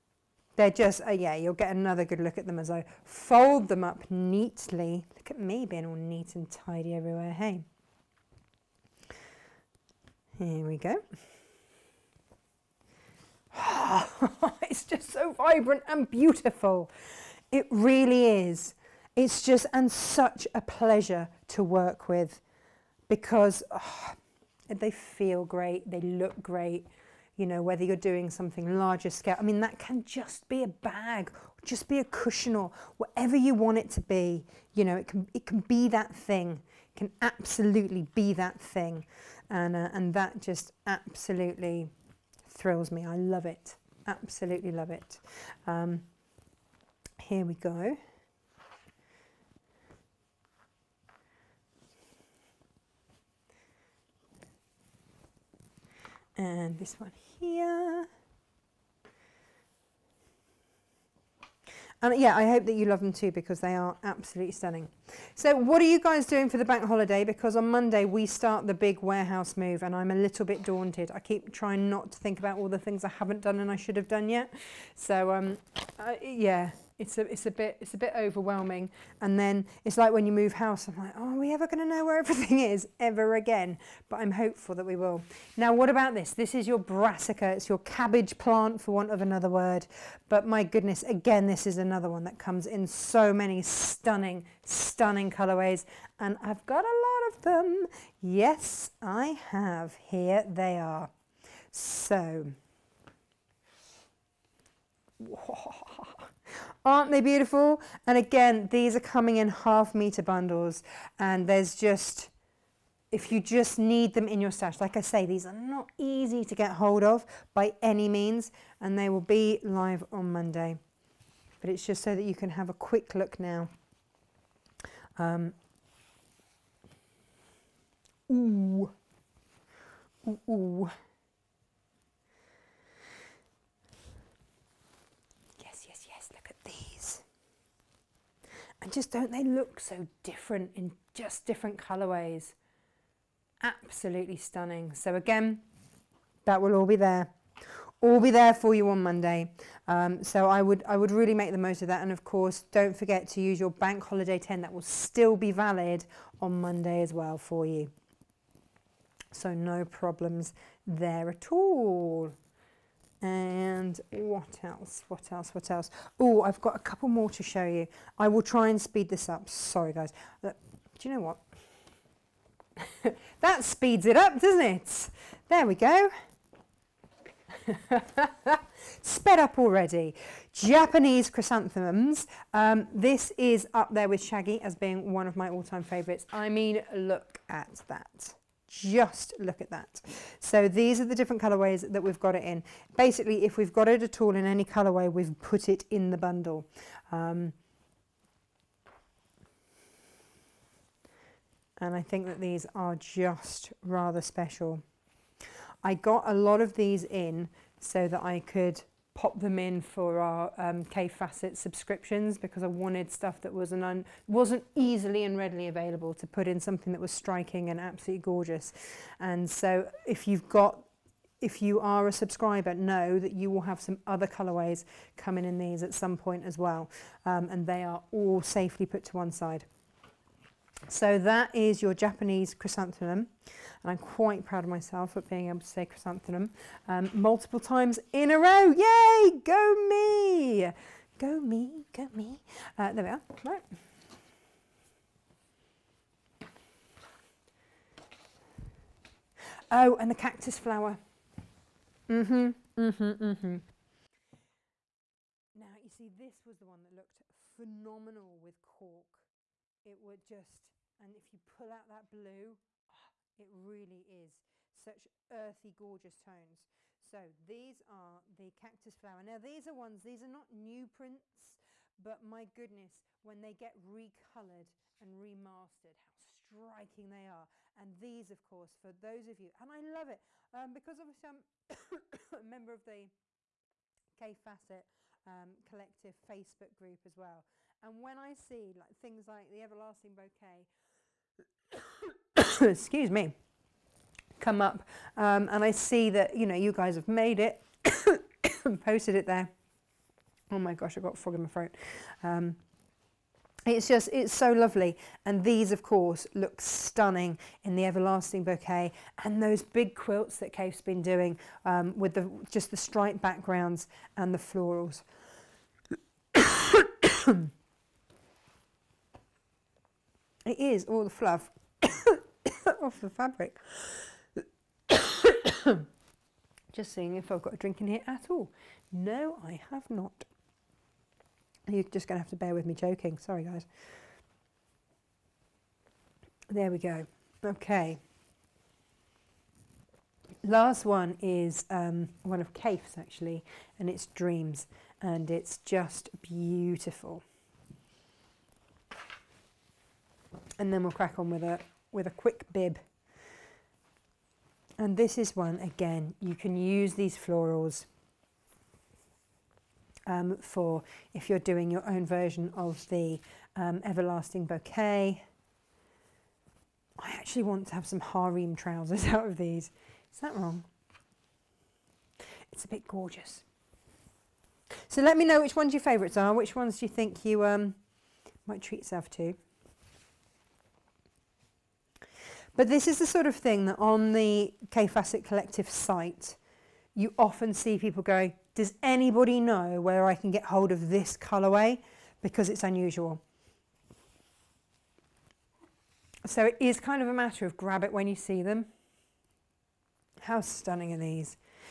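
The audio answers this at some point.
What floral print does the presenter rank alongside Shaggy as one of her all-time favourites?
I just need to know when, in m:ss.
3:00.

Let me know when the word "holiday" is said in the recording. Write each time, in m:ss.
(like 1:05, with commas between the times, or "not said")
1:06, 2:34.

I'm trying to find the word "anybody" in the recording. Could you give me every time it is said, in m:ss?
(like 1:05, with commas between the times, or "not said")
6:28.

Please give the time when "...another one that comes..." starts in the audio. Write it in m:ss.
1:31.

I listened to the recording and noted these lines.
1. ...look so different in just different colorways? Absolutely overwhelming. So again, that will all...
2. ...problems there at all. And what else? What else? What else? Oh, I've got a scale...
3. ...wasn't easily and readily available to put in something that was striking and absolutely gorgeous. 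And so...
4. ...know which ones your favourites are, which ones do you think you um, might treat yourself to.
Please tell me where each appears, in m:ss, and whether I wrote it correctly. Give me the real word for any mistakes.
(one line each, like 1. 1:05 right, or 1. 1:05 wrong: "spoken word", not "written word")
1. 2:19 wrong: "stunning", not "overwhelming"
2. 2:39 wrong: "couple", not "scale"
3. 3:34 right
4. 6:15 right.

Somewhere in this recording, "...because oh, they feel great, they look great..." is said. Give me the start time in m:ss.
0:23.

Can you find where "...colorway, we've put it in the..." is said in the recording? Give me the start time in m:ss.
3:14.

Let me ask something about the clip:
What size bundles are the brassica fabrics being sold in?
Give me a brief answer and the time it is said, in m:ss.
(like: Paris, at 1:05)
half meter, at 1:49.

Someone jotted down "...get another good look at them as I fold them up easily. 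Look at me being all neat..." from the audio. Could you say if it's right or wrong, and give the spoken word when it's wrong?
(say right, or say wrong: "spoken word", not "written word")
wrong: "neatly", not "easily".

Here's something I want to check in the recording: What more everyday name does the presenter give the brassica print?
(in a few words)
cabbage plant.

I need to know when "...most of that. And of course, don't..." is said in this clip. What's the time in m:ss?
2:31.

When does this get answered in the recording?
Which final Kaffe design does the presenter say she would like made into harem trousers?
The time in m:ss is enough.
5:44.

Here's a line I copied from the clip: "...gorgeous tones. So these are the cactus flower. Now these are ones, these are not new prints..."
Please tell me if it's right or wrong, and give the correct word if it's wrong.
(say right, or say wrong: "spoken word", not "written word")
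right.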